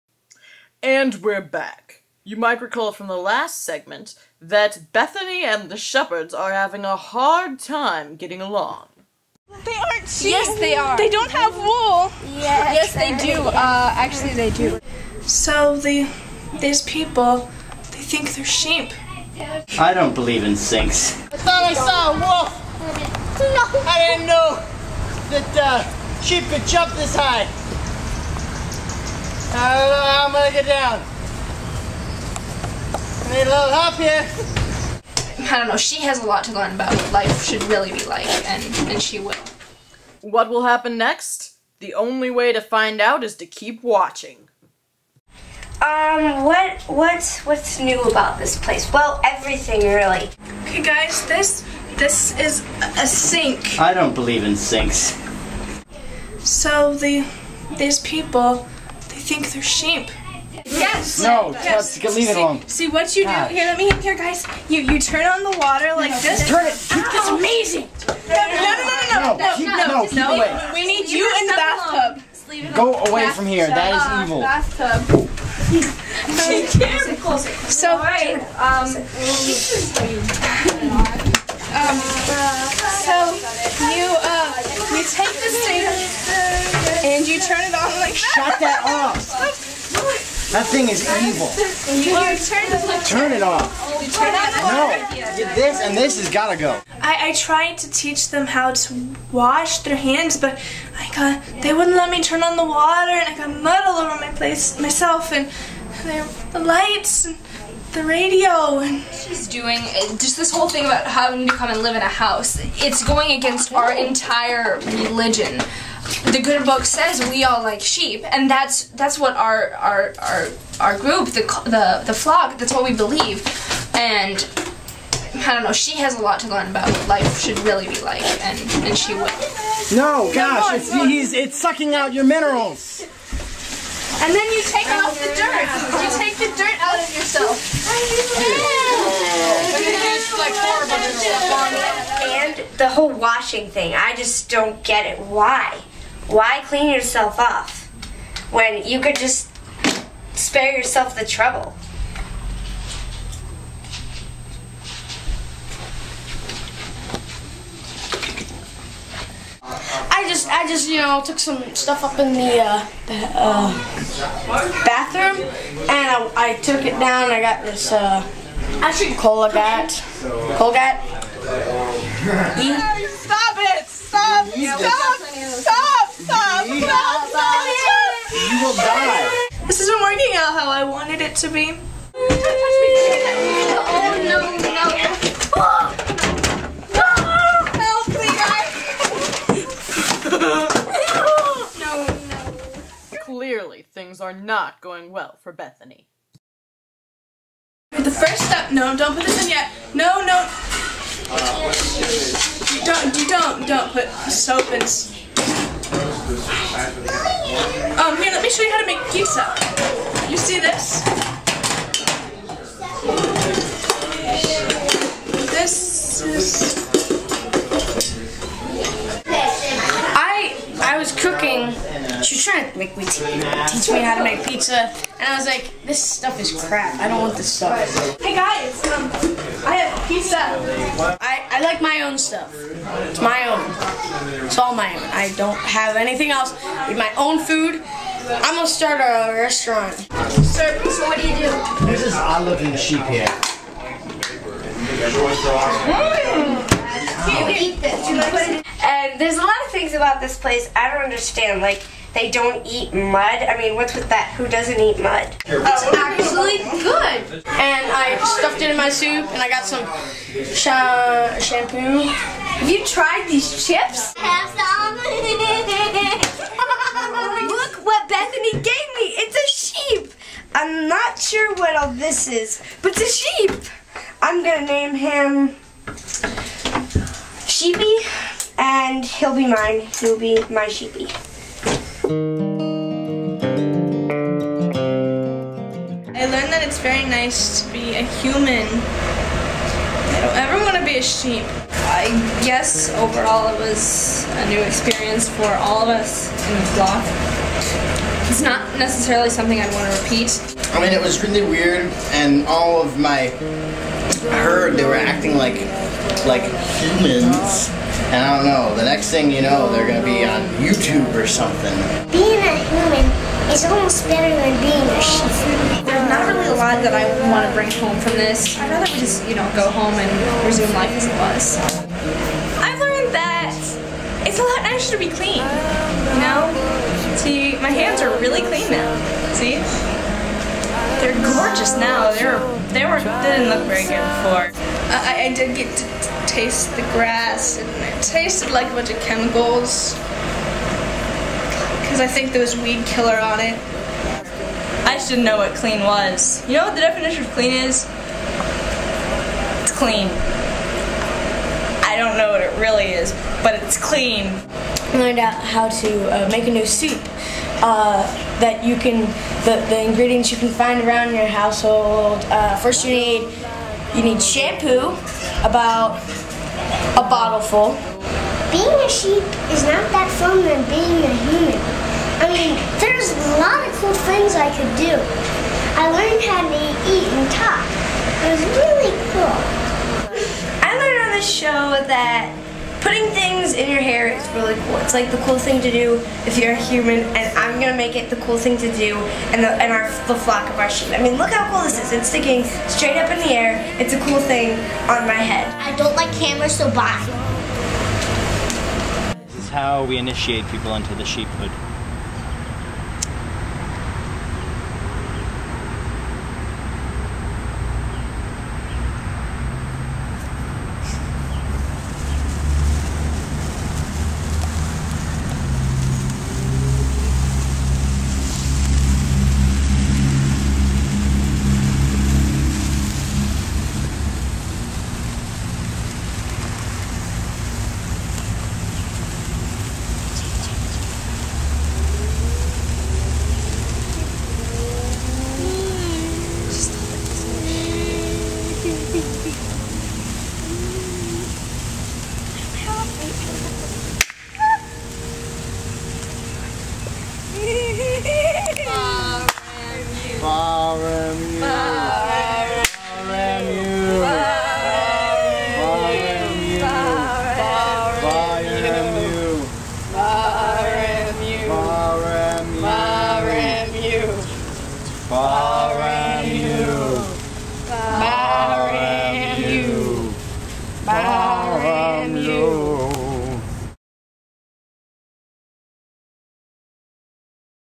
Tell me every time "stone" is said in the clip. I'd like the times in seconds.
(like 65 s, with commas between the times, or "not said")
not said.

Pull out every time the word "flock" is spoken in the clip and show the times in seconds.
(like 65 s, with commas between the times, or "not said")
122 s, 296 s, 390 s.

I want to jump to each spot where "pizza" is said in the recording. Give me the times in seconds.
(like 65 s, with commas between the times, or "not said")
209 s, 224 s, 230 s.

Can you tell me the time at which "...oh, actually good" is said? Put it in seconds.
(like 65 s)
255 s.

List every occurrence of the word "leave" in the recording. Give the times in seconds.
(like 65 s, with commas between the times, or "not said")
62 s.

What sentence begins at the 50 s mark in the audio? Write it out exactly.
Okay, guys, this, this is a sink.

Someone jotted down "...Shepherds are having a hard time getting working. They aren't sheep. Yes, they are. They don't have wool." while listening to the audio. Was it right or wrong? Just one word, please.
wrong.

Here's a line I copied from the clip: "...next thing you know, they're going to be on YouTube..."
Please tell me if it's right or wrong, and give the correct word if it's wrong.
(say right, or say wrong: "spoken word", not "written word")
right.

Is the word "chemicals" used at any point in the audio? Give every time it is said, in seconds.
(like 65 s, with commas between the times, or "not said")
338 s.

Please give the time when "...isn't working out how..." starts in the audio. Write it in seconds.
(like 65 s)
179 s.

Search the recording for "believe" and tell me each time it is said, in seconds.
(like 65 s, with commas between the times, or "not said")
20 s, 54 s, 122 s.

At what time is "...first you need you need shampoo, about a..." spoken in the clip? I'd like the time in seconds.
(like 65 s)
362 s.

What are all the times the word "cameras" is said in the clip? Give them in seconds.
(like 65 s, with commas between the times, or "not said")
396 s.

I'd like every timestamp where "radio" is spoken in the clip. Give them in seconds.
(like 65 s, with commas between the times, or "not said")
108 s.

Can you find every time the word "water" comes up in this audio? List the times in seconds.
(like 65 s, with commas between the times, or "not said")
65 s, 102 s.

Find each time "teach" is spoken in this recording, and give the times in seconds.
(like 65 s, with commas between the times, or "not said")
97 s, 223 s.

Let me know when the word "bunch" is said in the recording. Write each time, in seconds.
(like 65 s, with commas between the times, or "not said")
338 s.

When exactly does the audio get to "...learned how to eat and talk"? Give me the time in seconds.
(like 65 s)
375 s.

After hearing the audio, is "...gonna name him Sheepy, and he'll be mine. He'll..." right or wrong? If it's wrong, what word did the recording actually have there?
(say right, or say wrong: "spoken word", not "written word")
right.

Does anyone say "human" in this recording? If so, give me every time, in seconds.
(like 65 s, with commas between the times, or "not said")
288 s, 306 s, 312 s, 371 s, 386 s.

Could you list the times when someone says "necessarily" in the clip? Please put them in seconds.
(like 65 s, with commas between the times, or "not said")
298 s.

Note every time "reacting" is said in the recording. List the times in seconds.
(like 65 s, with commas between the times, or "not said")
not said.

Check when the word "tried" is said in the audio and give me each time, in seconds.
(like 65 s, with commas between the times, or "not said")
97 s, 262 s.